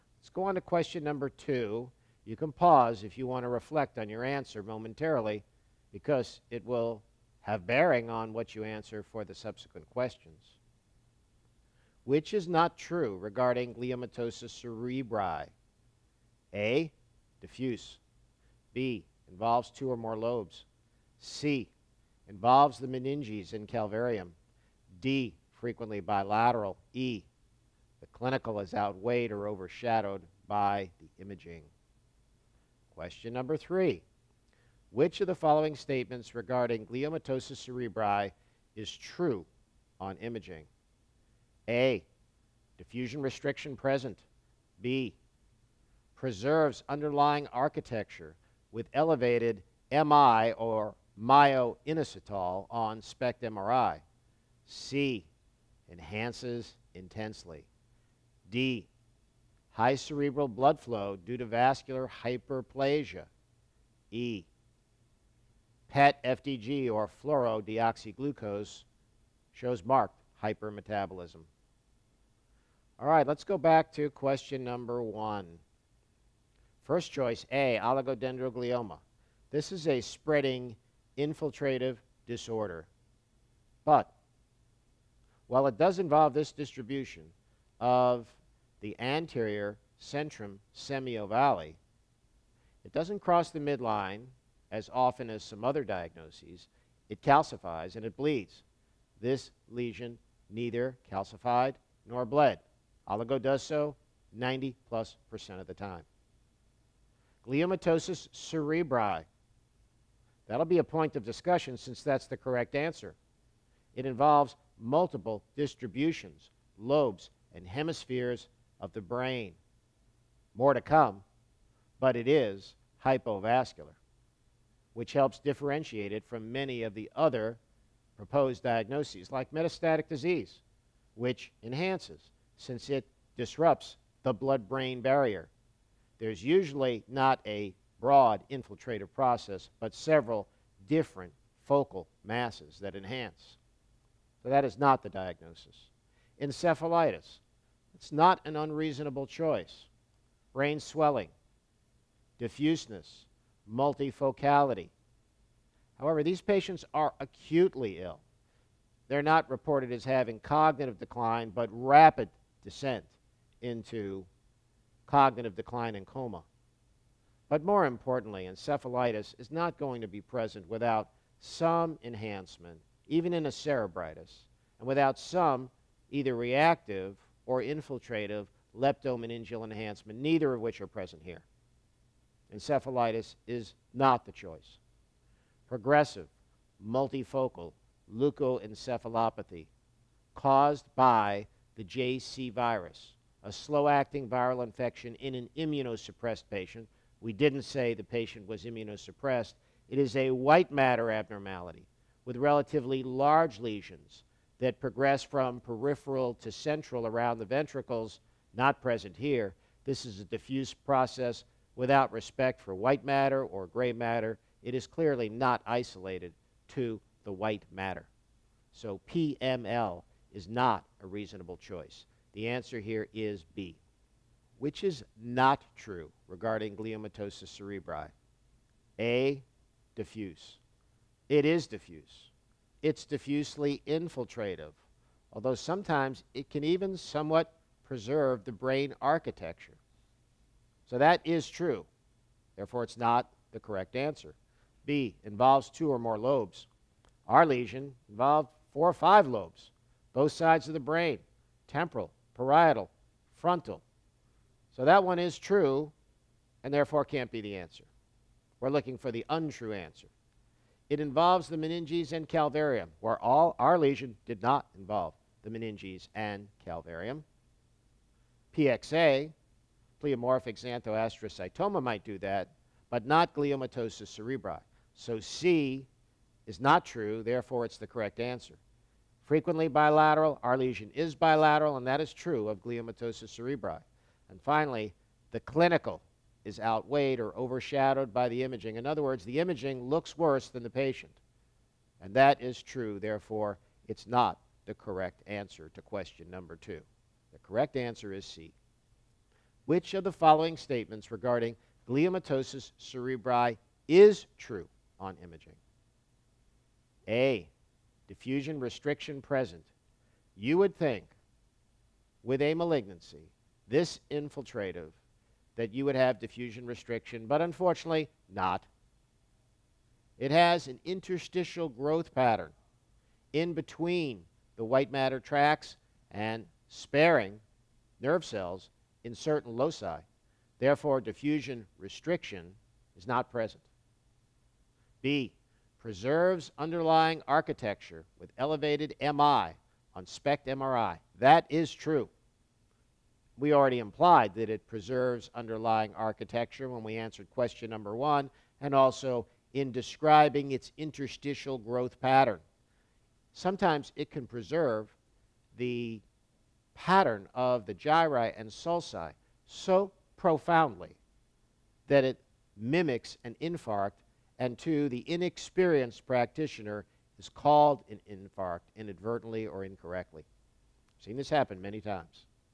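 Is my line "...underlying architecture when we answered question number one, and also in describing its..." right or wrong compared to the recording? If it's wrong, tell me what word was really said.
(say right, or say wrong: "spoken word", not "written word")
right.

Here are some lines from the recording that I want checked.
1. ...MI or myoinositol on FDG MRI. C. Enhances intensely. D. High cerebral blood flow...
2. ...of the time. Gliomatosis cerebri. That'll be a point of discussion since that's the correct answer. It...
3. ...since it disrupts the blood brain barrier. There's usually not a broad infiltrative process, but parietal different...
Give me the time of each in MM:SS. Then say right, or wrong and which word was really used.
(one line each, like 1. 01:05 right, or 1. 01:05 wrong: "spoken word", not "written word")
1. 00:49 wrong: "SPECT", not "FDG"
2. 01:45 right
3. 02:12 wrong: "several", not "parietal".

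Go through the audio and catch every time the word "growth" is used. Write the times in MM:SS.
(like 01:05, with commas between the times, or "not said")
05:21, 05:51.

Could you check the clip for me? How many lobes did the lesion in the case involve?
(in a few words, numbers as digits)
Four or five.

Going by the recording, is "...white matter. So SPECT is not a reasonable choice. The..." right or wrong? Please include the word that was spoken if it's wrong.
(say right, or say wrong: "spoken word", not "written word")
wrong: "PML", not "SPECT".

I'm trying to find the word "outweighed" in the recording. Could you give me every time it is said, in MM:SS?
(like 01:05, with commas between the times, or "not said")
00:28, 04:46.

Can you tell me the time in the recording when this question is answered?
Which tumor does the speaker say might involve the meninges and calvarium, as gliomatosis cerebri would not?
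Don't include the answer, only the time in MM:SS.
04:30.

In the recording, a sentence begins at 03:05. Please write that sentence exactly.
Progressive multifocal leukoencephalopathy caused by the JC virus, a slow-acting viral infection in an immunosuppressed patient.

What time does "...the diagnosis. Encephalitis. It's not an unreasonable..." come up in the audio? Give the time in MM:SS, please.
02:25.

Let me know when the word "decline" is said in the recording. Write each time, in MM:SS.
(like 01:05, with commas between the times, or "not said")
02:40, 02:45.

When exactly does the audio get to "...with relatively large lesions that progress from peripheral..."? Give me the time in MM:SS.
03:22.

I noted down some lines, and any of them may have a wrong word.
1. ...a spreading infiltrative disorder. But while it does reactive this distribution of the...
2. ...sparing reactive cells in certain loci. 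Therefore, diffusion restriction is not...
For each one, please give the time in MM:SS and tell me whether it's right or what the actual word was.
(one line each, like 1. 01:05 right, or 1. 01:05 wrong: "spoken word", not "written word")
1. 01:19 wrong: "involve", not "reactive"
2. 05:26 wrong: "nerve", not "reactive".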